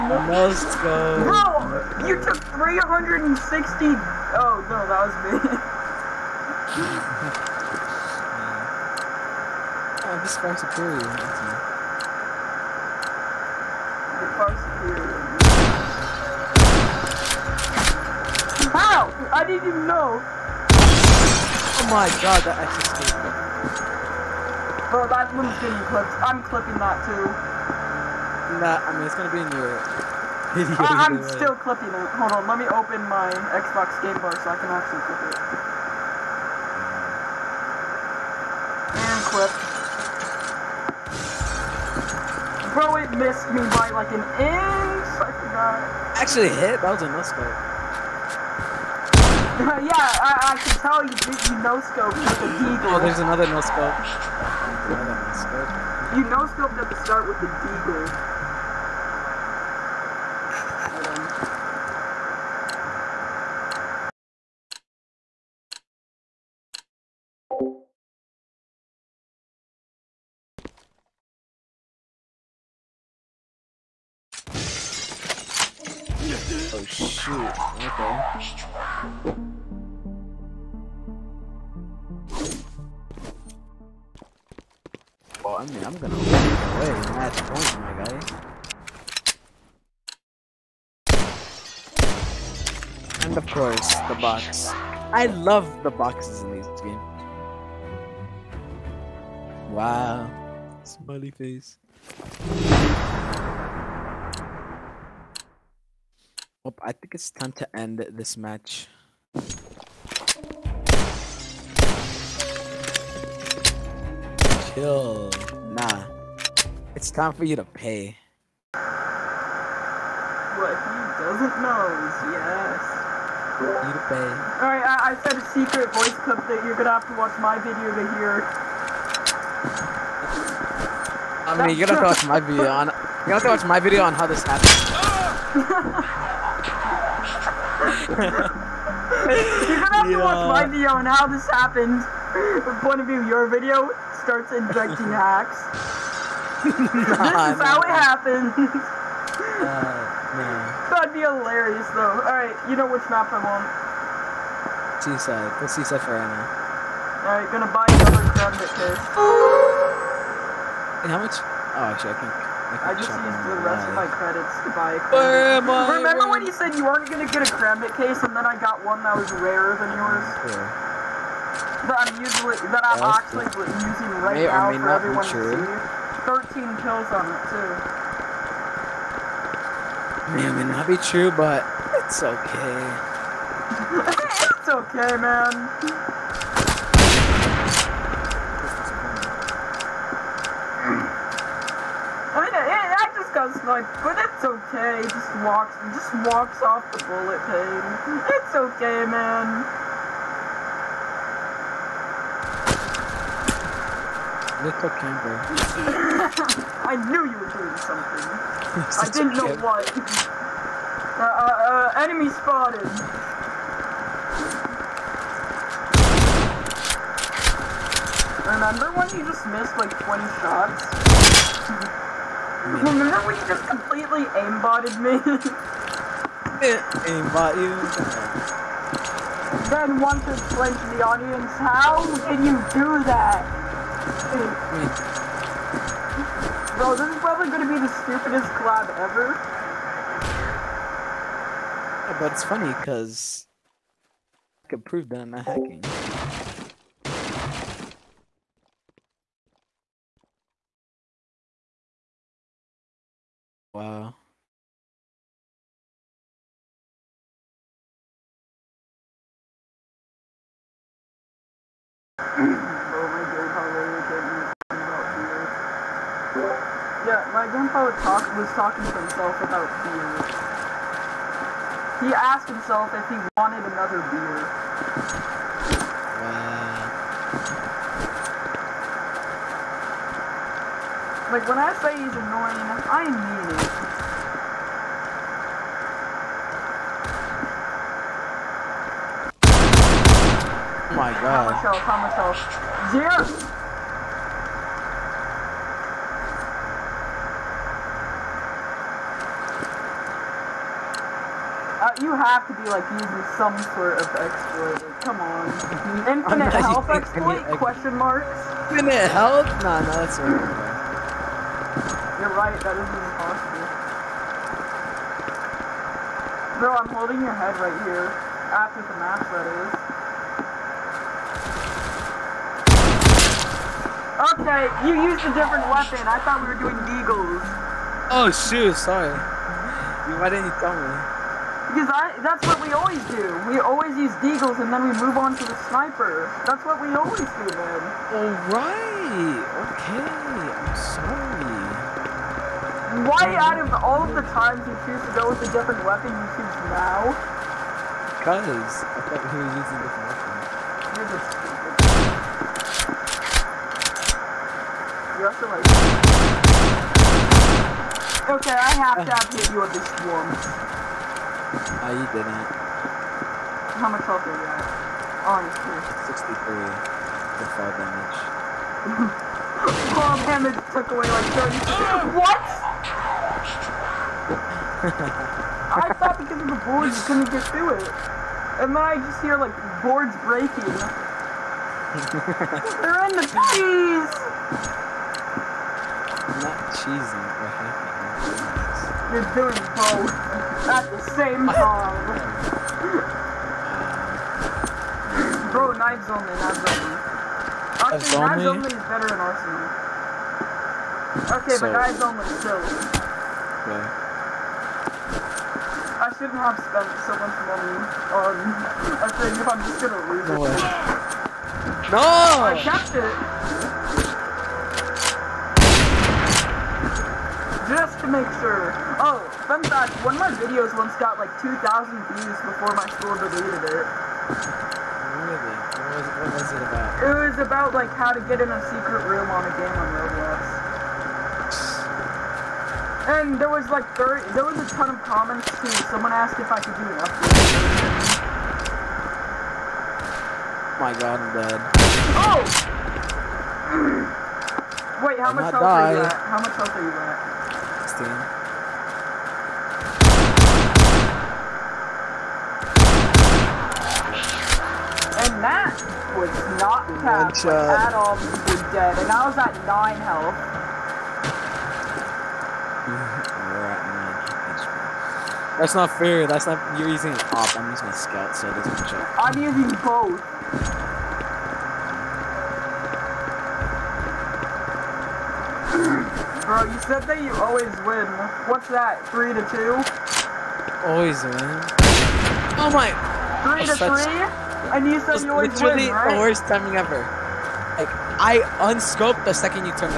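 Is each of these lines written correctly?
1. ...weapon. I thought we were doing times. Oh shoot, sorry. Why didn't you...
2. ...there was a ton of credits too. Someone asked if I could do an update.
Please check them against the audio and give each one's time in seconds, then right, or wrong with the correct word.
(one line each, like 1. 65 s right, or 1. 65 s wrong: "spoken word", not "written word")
1. 325 s wrong: "deagles", not "times"
2. 434 s wrong: "comments", not "credits".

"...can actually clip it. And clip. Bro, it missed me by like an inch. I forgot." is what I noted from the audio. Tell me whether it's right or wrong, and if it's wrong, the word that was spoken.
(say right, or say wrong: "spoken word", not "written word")
right.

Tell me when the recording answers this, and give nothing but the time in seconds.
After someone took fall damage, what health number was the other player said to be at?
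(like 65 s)
366 s.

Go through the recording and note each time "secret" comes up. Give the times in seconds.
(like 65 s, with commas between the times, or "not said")
125 s, 428 s.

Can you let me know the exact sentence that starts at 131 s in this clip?
I mean, you're gonna have to watch my video on.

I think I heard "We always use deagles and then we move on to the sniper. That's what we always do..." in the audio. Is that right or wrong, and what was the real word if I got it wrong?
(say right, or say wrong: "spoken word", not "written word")
right.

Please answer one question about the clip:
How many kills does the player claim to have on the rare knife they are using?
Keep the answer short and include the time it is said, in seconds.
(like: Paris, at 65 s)
13, at 176 s.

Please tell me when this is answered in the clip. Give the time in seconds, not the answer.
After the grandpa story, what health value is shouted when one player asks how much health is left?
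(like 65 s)
292 s.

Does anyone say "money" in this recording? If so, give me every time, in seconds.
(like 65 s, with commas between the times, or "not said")
407 s.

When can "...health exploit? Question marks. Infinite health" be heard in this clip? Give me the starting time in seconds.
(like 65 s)
306 s.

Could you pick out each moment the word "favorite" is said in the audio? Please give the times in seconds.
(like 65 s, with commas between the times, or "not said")
not said.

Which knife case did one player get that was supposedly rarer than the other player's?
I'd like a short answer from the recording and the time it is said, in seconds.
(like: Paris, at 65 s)
Karambit, at 167 s.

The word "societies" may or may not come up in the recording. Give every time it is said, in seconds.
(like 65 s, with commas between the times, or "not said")
not said.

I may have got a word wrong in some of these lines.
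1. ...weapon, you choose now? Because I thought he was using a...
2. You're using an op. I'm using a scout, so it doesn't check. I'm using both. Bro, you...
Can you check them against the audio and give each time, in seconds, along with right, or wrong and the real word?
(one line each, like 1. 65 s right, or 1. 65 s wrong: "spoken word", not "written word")
1. 345 s right
2. 466 s right.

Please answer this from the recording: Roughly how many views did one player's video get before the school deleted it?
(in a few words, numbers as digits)
2,000.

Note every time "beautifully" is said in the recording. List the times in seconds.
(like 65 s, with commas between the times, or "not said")
not said.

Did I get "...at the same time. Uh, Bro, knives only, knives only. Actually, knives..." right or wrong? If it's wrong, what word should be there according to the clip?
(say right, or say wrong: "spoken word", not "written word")
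right.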